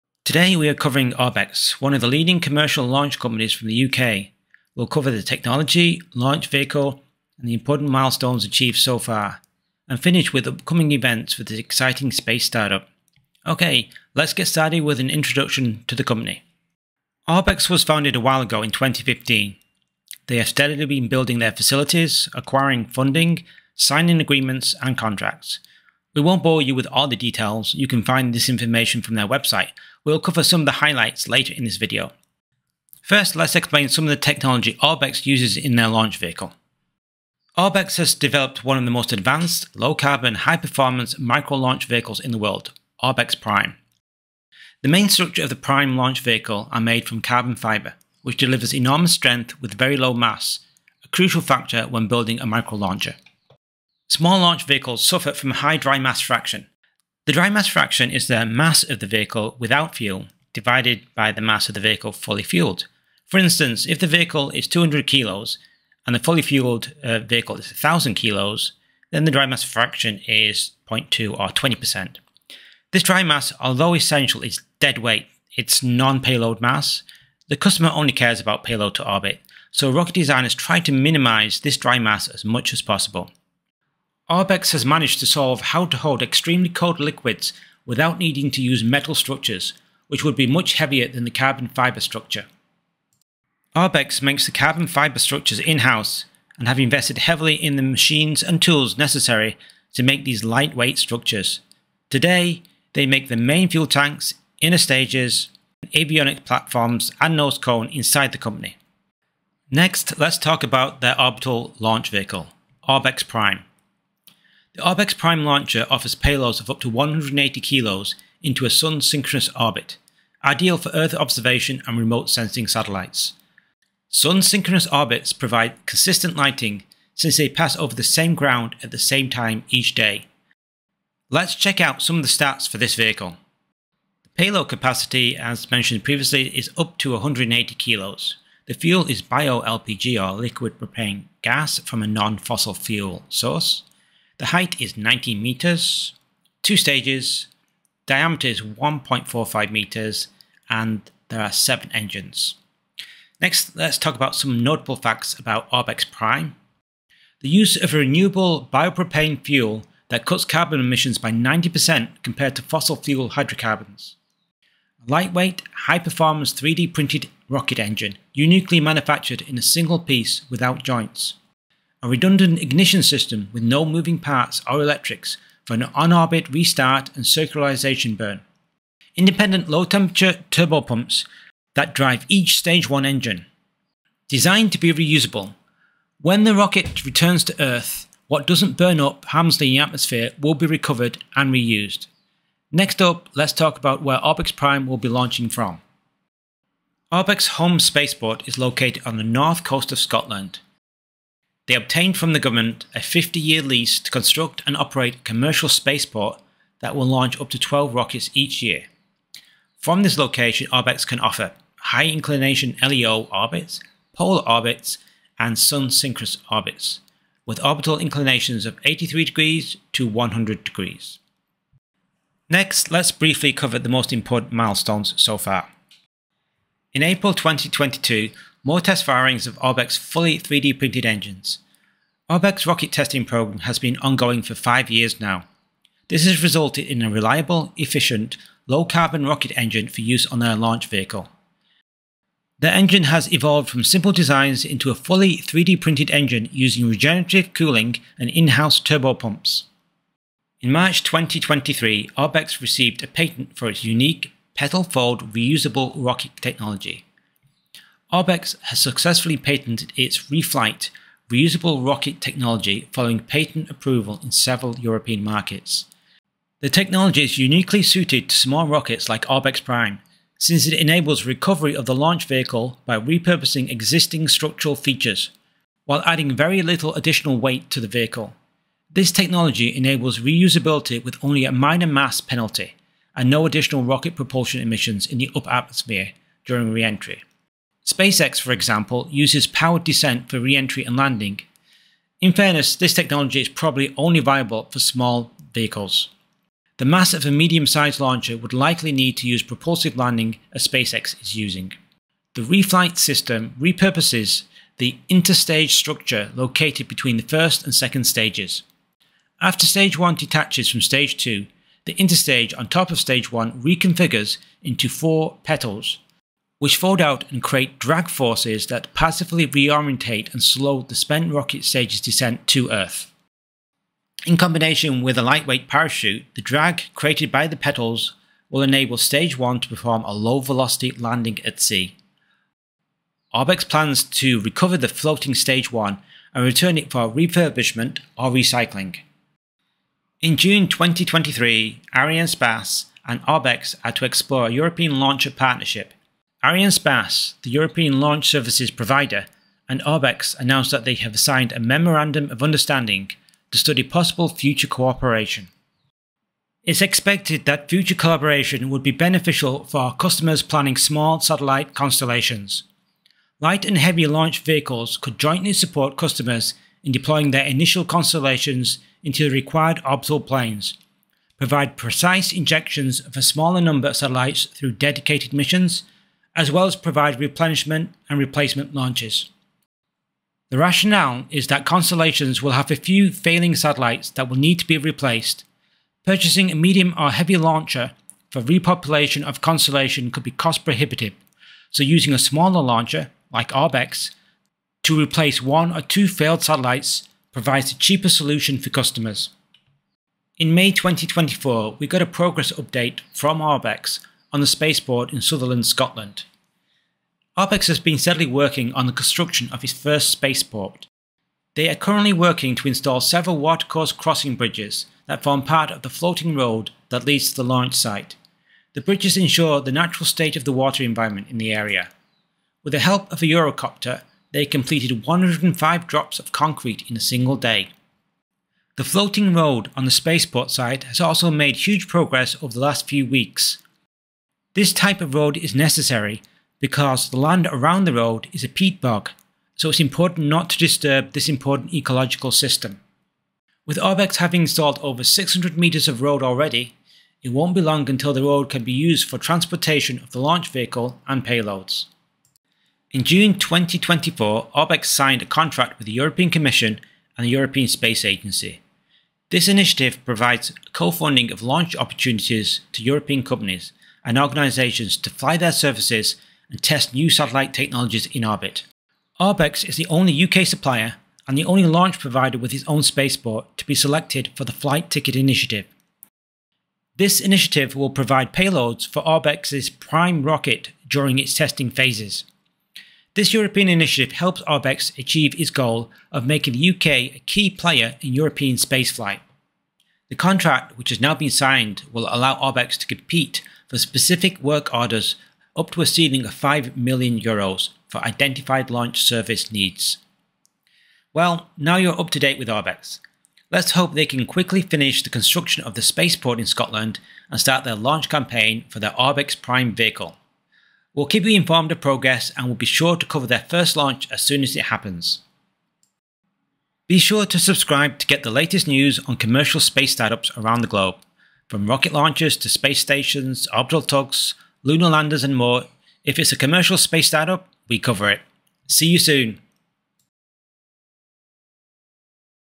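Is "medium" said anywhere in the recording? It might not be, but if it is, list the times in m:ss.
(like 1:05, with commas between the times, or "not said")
4:57, 6:26.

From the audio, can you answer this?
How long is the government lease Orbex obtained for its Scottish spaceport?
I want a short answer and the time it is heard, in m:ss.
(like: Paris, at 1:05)
50 years, at 3:22.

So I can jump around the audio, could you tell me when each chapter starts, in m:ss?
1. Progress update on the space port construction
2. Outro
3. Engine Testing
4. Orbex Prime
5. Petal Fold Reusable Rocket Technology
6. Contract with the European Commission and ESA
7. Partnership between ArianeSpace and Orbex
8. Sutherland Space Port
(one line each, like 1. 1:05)
1. 6:41
2. 8:36
3. 3:49
4. 1:50
5. 4:10
6. 7:32
7. 5:39
8. 3:17.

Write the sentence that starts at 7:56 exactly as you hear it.
This initiative will provide payloads for Orbex's prime rocket during its testing phases.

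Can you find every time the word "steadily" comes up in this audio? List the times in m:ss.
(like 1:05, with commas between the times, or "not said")
0:20, 6:47.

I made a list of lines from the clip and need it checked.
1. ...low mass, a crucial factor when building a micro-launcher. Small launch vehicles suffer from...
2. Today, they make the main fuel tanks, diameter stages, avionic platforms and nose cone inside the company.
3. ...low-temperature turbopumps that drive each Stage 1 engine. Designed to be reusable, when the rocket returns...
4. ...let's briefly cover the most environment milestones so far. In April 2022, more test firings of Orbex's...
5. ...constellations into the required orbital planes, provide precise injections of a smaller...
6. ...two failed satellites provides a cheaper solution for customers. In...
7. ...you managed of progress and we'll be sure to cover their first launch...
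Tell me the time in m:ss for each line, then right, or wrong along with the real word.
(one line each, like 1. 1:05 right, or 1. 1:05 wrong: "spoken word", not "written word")
1. 0:49 right
2. 1:42 wrong: "inner", not "diameter"
3. 2:59 right
4. 3:42 wrong: "important", not "environment"
5. 6:07 right
6. 6:35 right
7. 8:31 wrong: "informed", not "managed".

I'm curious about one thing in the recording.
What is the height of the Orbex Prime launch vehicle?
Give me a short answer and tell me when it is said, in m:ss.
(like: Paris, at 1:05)
19 meters, at 2:24.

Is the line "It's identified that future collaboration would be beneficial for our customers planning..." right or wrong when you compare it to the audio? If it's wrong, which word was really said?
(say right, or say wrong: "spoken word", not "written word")
wrong: "expected", not "identified".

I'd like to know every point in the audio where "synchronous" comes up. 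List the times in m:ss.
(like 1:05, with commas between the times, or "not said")
1:59, 2:04, 3:35.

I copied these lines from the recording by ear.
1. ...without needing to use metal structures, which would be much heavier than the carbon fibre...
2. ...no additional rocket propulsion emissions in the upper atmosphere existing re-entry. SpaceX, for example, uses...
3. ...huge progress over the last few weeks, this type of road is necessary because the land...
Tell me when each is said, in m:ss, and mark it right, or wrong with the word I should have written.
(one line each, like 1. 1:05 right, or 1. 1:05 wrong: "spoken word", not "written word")
1. 1:27 right
2. 4:43 wrong: "during", not "existing"
3. 7:11 right.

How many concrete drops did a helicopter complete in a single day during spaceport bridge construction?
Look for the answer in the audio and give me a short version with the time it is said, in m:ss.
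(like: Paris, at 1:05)
105, at 7:05.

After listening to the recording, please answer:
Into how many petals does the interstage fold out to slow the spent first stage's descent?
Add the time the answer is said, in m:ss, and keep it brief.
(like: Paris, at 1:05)
4, at 5:14.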